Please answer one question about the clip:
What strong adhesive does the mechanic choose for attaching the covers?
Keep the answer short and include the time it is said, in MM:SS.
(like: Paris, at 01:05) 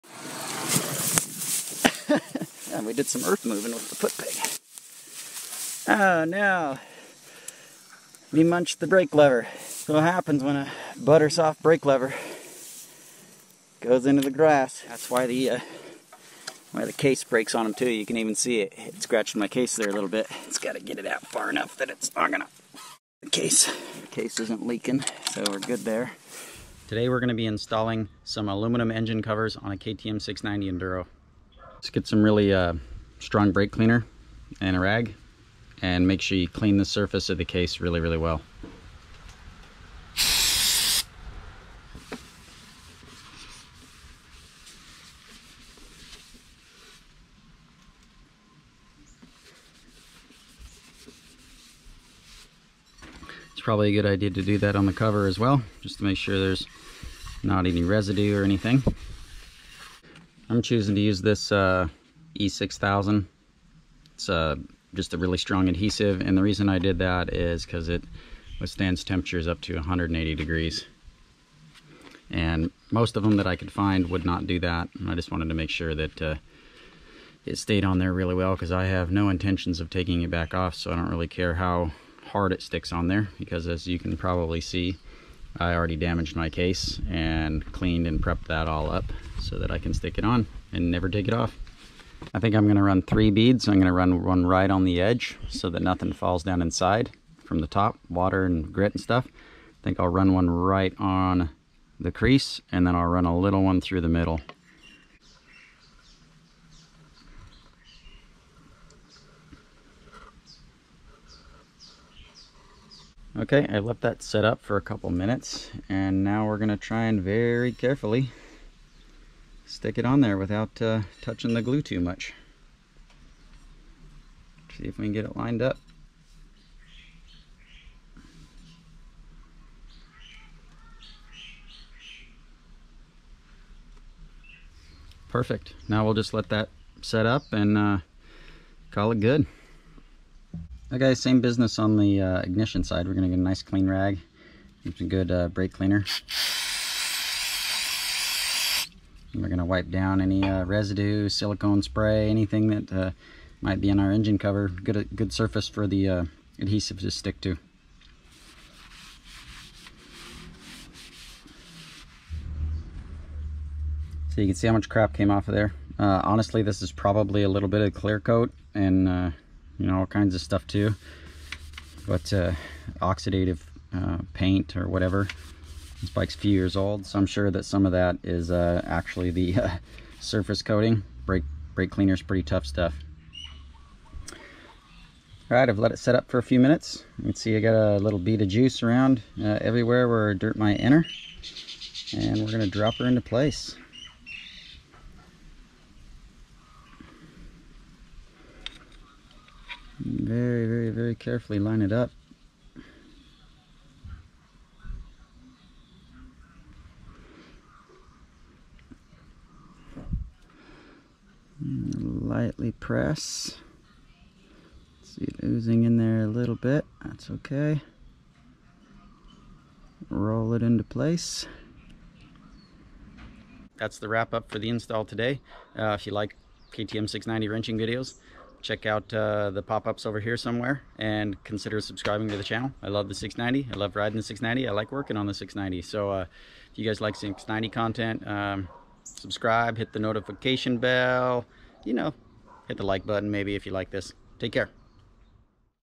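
E6000, at 01:02.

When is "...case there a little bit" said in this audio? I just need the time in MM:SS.
00:19.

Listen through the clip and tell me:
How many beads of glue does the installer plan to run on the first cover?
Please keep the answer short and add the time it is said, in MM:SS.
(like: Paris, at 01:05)
3, at 01:33.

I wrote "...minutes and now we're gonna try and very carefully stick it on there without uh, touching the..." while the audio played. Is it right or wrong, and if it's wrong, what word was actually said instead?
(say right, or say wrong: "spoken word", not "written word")
right.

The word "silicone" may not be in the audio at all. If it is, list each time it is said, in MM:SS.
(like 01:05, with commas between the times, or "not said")
02:31.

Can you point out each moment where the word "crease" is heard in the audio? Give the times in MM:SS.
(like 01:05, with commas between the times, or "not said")
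01:42.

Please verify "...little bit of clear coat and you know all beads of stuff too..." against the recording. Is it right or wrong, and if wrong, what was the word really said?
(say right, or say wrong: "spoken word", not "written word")
wrong: "kinds", not "beads".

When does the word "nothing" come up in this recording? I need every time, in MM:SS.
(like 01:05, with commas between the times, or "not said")
01:35.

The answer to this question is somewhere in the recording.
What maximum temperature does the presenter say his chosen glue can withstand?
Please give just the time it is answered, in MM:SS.
01:09.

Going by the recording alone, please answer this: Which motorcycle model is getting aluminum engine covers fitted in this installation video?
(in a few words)
KTM 690 Enduro.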